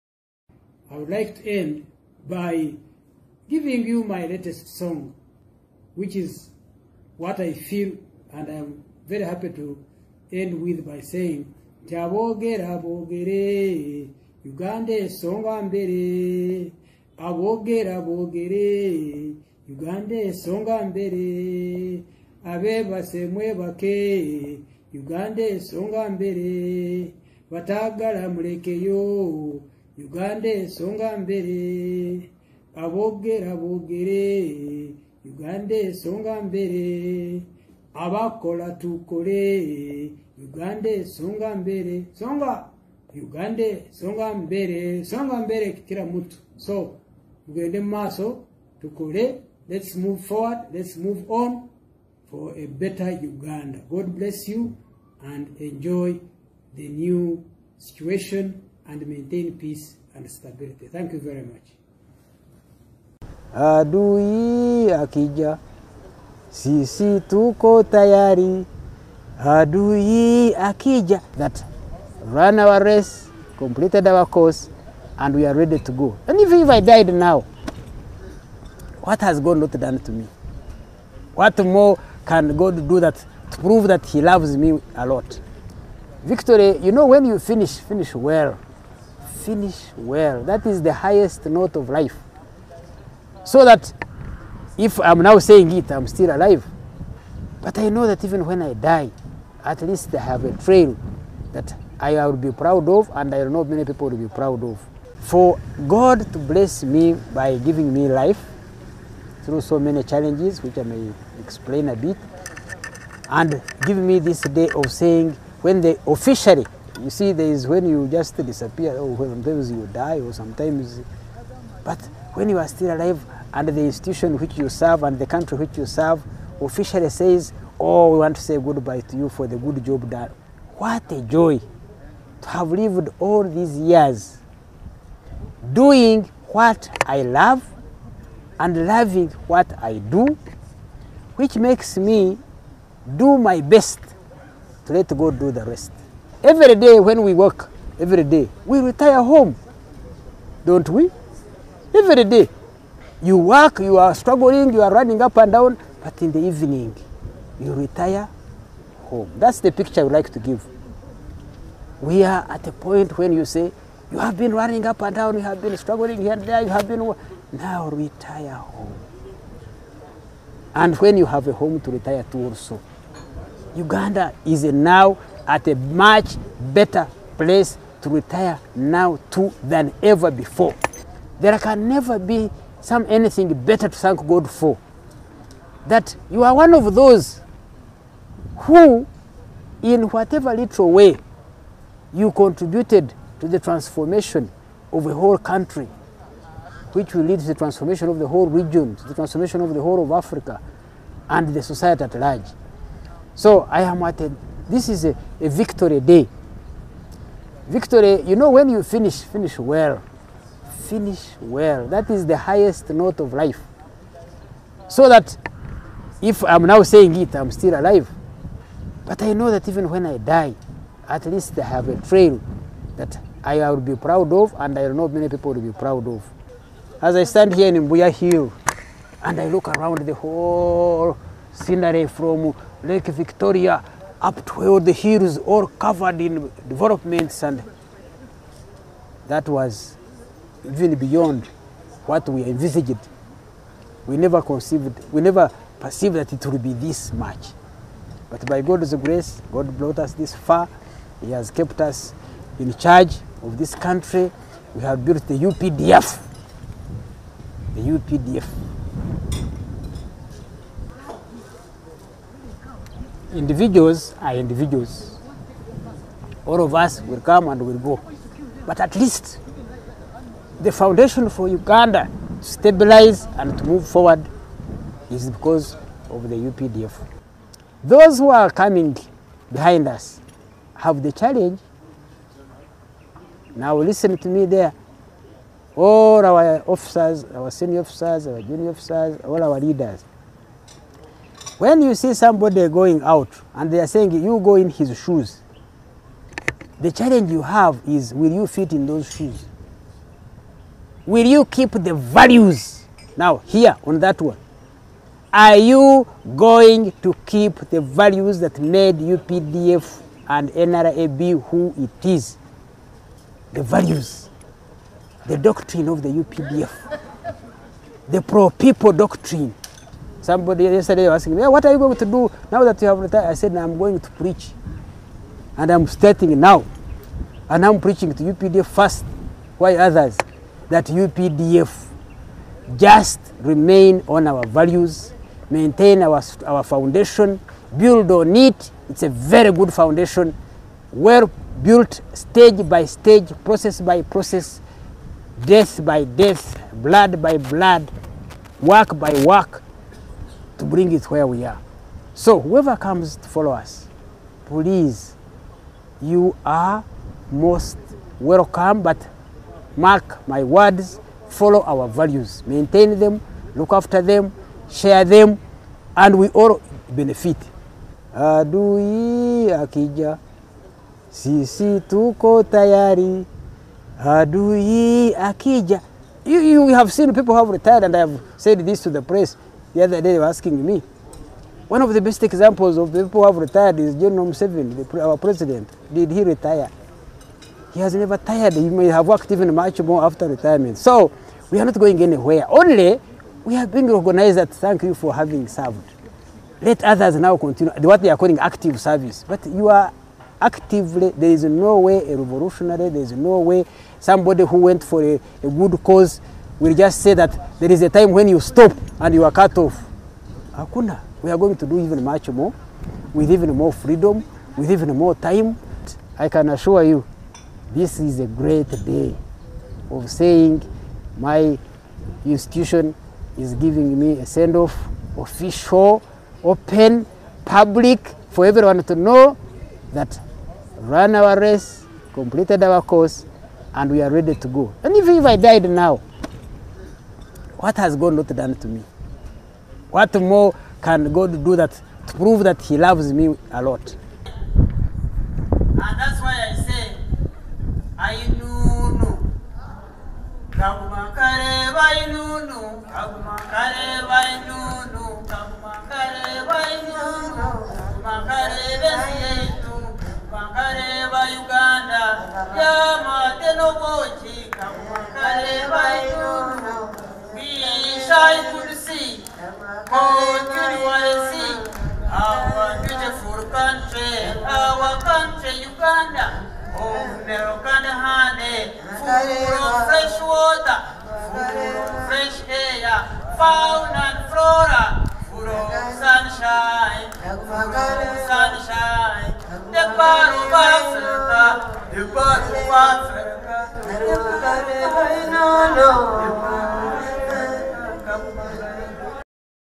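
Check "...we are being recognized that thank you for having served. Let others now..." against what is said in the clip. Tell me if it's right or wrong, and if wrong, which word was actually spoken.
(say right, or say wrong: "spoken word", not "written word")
right.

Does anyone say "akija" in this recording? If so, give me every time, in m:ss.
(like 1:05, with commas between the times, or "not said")
1:04, 1:10, 6:09, 6:15.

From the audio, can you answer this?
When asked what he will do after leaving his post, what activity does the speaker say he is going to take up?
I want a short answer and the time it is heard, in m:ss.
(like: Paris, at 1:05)
Preach, at 5:24.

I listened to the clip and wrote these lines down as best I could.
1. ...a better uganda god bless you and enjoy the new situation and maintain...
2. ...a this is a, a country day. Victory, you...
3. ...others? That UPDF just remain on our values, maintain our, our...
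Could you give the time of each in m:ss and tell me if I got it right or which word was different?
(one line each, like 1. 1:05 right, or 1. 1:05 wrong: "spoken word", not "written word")
1. 0:52 right
2. 3:24 wrong: "victory", not "country"
3. 5:29 right.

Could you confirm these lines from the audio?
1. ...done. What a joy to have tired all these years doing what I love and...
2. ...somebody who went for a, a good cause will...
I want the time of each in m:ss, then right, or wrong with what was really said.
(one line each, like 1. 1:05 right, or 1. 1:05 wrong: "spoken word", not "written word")
1. 2:10 wrong: "lived", not "tired"
2. 6:43 right.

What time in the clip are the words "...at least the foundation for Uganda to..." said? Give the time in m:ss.
4:28.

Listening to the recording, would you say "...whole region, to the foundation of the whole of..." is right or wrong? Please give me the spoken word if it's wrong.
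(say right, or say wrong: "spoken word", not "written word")
wrong: "transformation", not "foundation".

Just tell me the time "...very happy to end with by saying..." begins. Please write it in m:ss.
0:09.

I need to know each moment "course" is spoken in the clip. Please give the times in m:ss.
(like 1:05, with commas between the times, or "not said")
1:14, 7:12.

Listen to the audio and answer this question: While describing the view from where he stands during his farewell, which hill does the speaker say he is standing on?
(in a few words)
Mbuya Hill.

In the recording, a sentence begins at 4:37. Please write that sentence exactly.
Those who are coming behind us have the challenge.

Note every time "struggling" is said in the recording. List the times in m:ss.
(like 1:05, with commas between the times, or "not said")
2:34, 2:45.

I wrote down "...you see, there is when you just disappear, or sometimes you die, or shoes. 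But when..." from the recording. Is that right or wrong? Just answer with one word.
wrong.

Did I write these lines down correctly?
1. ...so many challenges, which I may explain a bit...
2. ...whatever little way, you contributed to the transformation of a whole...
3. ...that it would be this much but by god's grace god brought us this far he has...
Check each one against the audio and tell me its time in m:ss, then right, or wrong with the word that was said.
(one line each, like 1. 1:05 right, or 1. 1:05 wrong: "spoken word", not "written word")
1. 1:49 right
2. 3:10 right
3. 4:06 right.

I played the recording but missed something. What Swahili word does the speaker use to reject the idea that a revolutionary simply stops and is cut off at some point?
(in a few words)
Hakuna.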